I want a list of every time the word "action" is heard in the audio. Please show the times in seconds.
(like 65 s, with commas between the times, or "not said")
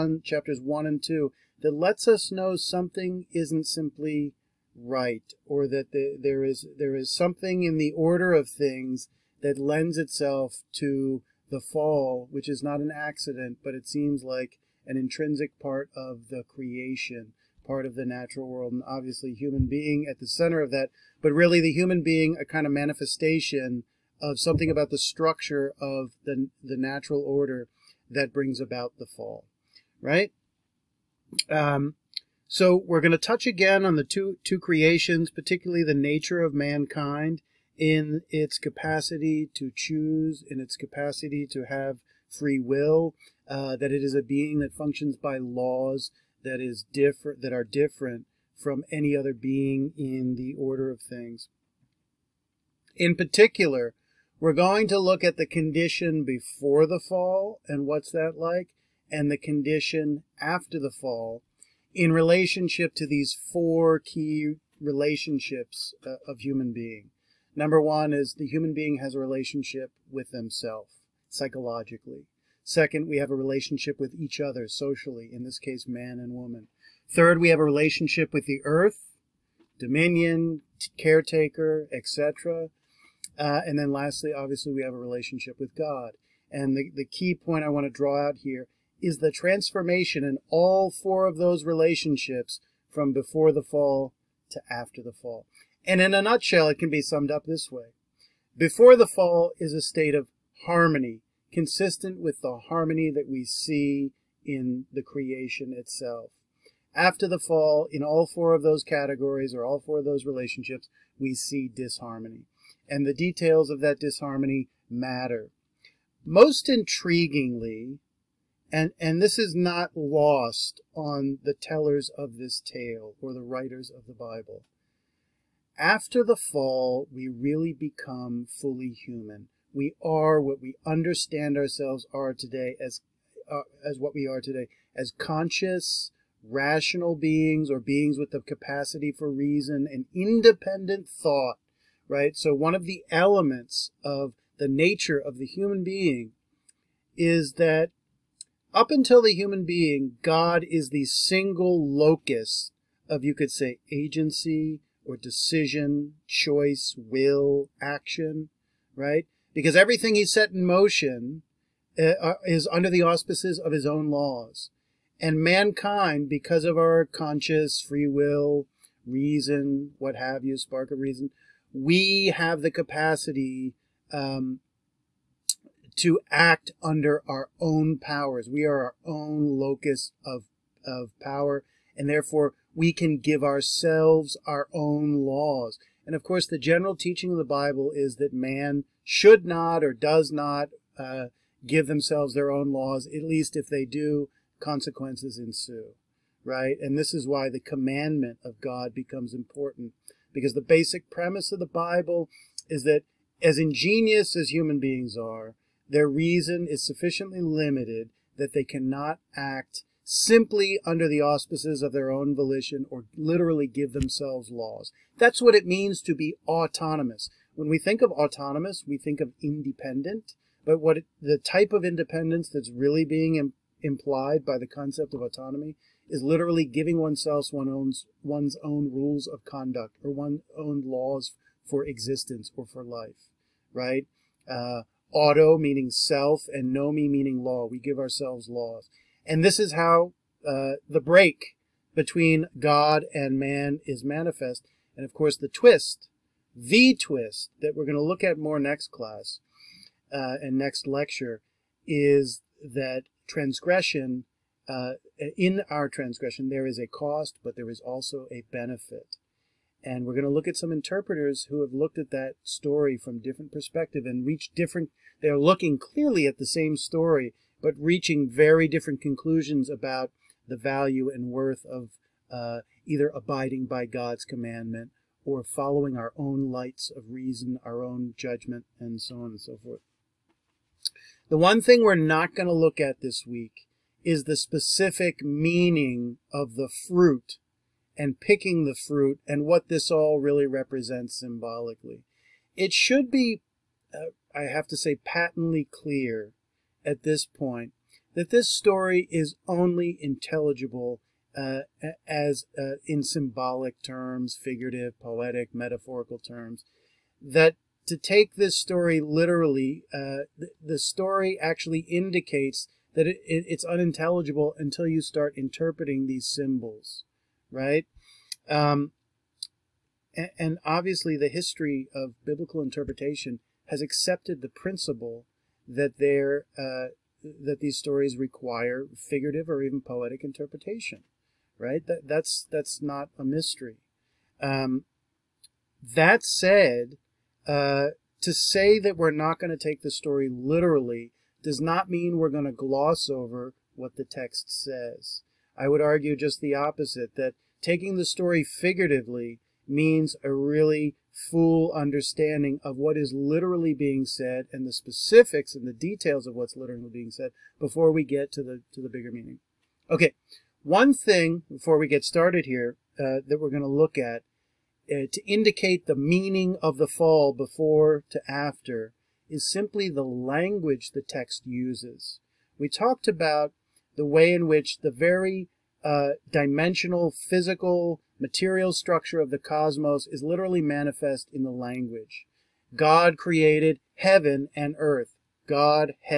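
157 s.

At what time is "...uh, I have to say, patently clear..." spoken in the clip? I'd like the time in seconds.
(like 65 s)
293 s.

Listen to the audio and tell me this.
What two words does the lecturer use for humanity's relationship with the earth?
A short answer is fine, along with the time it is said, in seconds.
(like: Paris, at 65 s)
Dominion, caretaker, at 79 s.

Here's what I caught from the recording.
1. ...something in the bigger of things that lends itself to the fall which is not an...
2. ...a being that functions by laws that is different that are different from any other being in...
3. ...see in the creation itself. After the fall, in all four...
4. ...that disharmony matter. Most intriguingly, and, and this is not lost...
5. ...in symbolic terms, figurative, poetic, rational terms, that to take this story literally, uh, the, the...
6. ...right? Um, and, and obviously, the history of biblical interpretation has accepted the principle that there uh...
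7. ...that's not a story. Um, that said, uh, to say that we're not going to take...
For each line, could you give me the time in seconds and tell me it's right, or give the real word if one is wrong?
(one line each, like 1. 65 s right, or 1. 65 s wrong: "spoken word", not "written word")
1. 7 s wrong: "order", not "bigger"
2. 44 s right
3. 103 s right
4. 113 s right
5. 302 s wrong: "metaphorical", not "rational"
6. 317 s right
7. 332 s wrong: "mystery", not "story".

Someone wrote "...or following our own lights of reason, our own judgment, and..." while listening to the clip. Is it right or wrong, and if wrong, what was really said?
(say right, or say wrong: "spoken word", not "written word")
right.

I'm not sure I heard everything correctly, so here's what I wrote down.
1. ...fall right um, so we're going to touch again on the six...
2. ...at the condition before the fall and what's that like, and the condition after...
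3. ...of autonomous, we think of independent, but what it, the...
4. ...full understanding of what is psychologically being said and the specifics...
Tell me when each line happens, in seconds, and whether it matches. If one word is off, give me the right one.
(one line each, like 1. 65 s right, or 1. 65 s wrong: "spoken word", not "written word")
1. 29 s wrong: "two", not "six"
2. 55 s right
3. 218 s right
4. 351 s wrong: "literally", not "psychologically".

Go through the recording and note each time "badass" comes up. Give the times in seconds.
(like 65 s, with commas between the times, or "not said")
not said.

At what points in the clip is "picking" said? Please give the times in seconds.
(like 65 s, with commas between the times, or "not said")
288 s.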